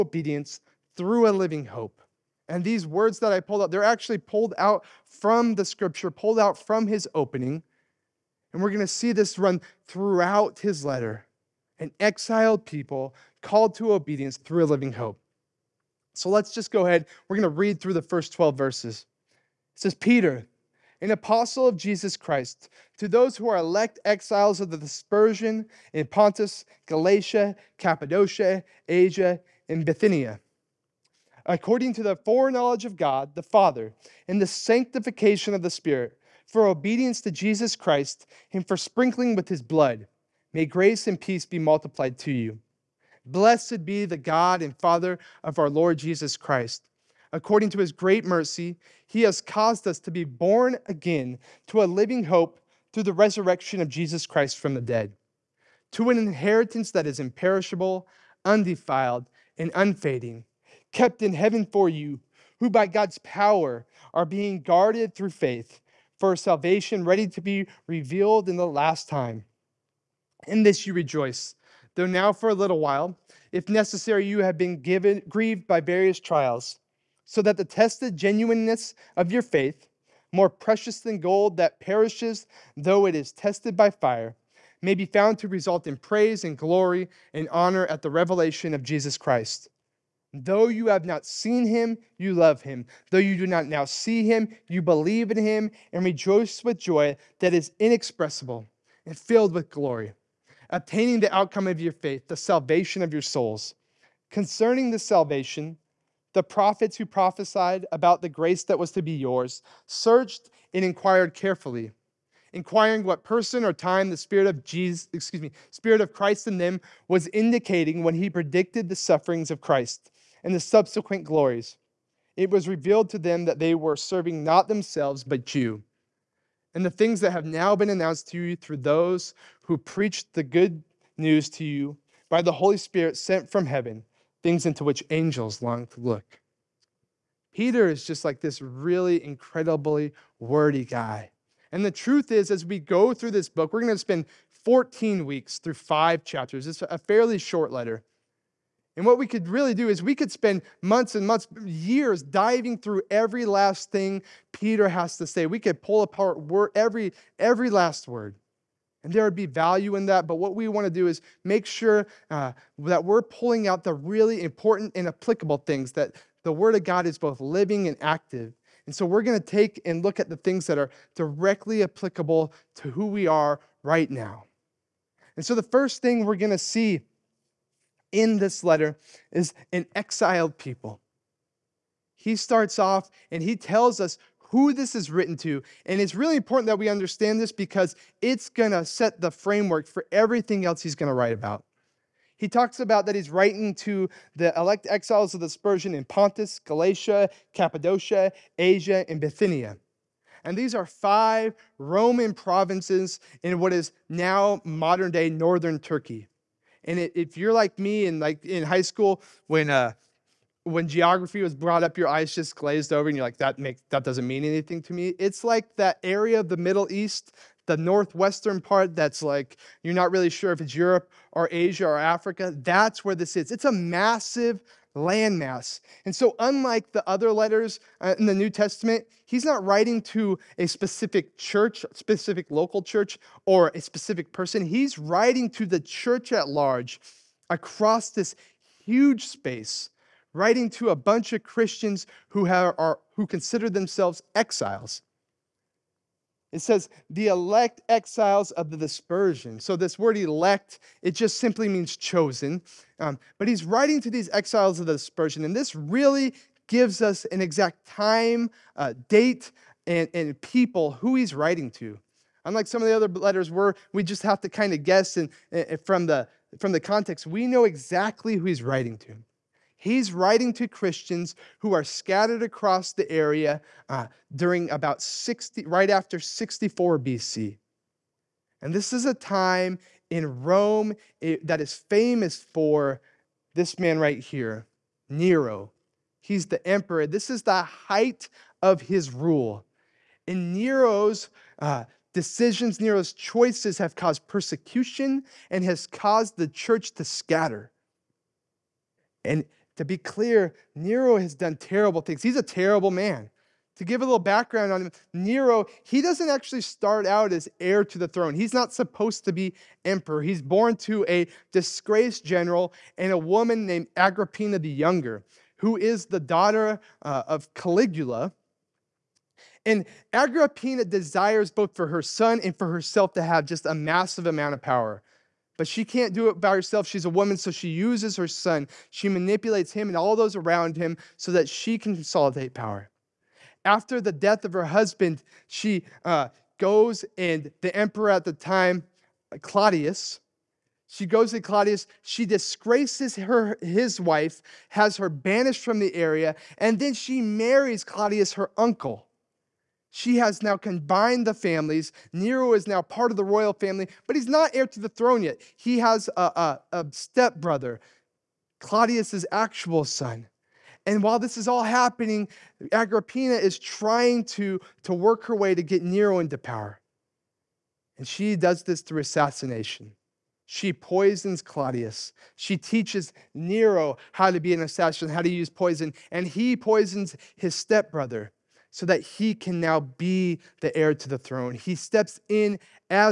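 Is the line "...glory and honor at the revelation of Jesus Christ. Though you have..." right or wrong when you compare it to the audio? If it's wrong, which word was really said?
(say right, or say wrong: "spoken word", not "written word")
right.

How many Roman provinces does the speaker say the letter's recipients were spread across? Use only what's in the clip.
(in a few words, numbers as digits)
5.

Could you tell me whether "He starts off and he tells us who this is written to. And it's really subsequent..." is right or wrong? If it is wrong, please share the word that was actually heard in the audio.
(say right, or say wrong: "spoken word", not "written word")
wrong: "important", not "subsequent".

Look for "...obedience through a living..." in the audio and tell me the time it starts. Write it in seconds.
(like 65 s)
13 s.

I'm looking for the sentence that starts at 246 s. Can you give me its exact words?
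It says, the elect exiles of the dispersion.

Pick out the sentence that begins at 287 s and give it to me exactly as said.
This is the height of his rule.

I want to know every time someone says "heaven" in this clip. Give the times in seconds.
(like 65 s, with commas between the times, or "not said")
61 s, 133 s.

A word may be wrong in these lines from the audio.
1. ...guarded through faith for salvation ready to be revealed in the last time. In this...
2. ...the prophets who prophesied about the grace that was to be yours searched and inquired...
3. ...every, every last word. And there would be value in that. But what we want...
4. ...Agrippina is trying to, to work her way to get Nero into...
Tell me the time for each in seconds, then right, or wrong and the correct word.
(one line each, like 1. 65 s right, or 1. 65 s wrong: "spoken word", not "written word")
1. 64 s right
2. 106 s right
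3. 156 s right
4. 362 s right.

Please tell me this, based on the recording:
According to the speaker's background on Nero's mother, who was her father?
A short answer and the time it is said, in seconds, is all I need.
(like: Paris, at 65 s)
Caligula, at 317 s.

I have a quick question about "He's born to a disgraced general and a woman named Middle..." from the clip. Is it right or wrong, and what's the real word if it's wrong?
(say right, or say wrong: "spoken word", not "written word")
wrong: "Agrippina", not "Middle".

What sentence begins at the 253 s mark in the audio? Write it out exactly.
Um, but he's writing to these exiles of the dispersion.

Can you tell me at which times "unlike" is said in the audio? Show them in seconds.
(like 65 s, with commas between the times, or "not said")
226 s, 262 s.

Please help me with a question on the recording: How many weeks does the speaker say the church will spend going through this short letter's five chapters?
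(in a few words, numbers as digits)
14.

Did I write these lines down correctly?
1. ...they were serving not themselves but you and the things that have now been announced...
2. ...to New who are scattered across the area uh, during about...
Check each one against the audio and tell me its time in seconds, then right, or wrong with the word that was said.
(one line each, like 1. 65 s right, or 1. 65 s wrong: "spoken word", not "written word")
1. 123 s right
2. 270 s wrong: "Christians", not "New".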